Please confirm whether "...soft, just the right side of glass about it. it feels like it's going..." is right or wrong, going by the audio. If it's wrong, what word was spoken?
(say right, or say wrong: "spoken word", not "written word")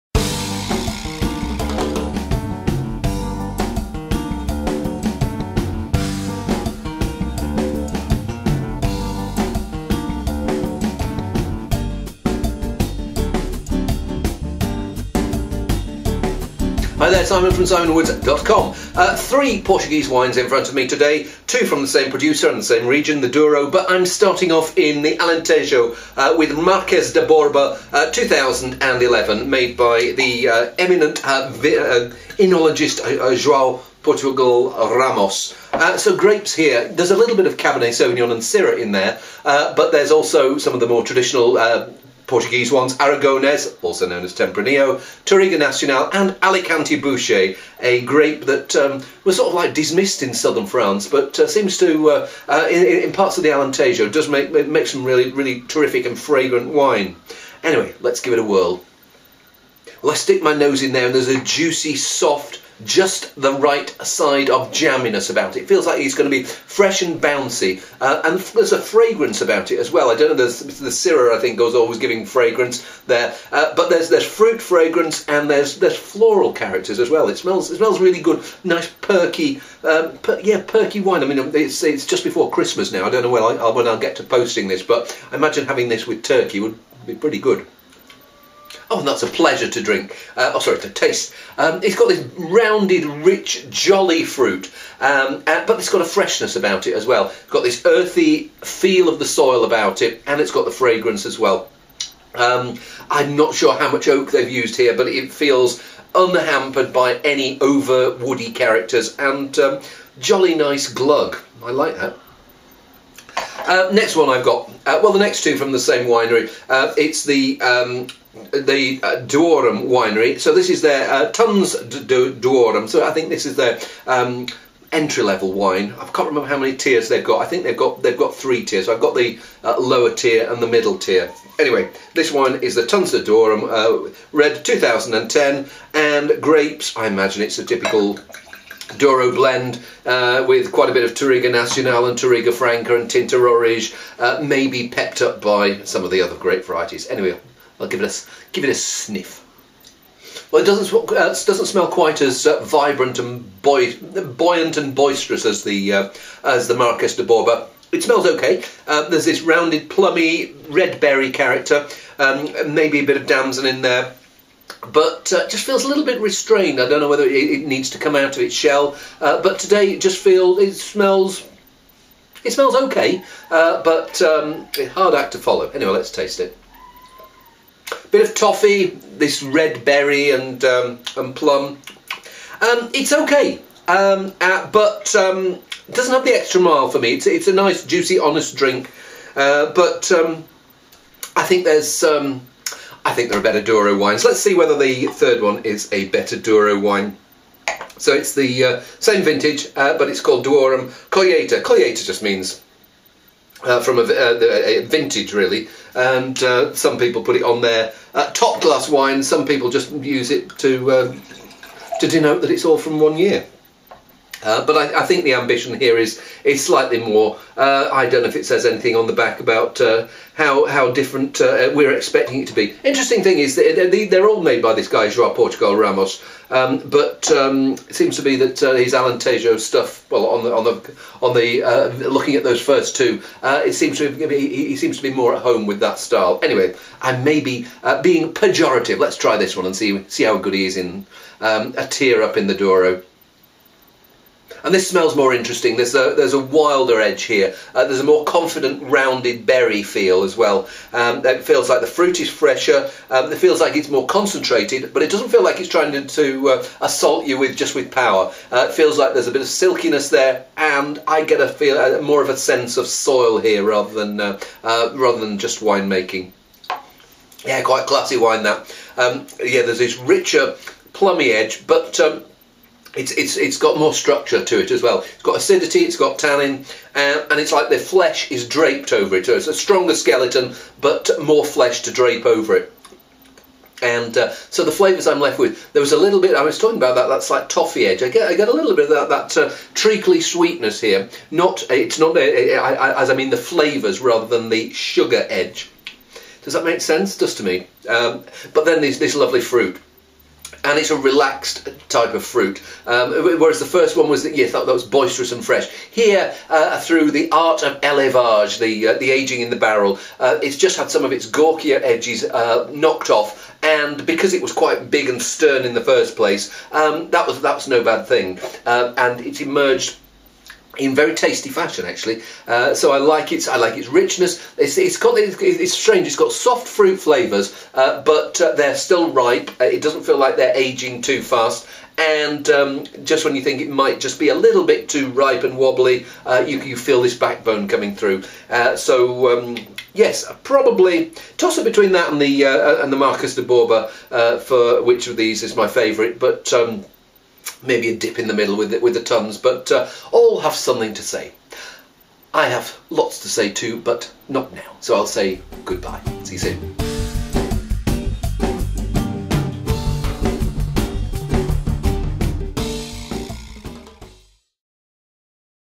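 wrong: "jamminess", not "glass".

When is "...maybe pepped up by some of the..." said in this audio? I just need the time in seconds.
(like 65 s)
144 s.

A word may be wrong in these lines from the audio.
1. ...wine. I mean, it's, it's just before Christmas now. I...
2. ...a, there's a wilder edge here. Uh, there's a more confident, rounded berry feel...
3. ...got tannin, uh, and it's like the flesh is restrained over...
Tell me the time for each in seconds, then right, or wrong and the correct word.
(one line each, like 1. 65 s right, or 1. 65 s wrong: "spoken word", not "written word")
1. 81 s right
2. 245 s right
3. 275 s wrong: "draped", not "restrained".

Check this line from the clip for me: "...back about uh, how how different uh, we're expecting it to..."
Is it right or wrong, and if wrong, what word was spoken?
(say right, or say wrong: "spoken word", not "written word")
right.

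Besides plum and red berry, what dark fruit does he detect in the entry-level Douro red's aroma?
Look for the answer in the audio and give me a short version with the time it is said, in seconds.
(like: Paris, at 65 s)
damson, at 163 s.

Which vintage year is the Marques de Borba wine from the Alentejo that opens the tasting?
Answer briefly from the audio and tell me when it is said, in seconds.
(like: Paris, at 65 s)
2011, at 28 s.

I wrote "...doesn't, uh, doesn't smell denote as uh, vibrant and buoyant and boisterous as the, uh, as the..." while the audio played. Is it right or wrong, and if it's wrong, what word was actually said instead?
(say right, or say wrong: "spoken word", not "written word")
wrong: "quite", not "denote".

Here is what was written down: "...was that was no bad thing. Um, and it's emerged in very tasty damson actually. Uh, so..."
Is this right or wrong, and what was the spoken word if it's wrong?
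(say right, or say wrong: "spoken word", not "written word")
wrong: "fashion", not "damson".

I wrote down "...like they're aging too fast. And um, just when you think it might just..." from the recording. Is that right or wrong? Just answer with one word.
right.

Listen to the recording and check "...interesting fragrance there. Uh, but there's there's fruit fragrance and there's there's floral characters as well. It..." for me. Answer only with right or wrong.
wrong.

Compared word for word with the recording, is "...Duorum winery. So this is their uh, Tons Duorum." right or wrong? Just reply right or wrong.
right.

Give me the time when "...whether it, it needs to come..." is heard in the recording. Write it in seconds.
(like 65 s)
167 s.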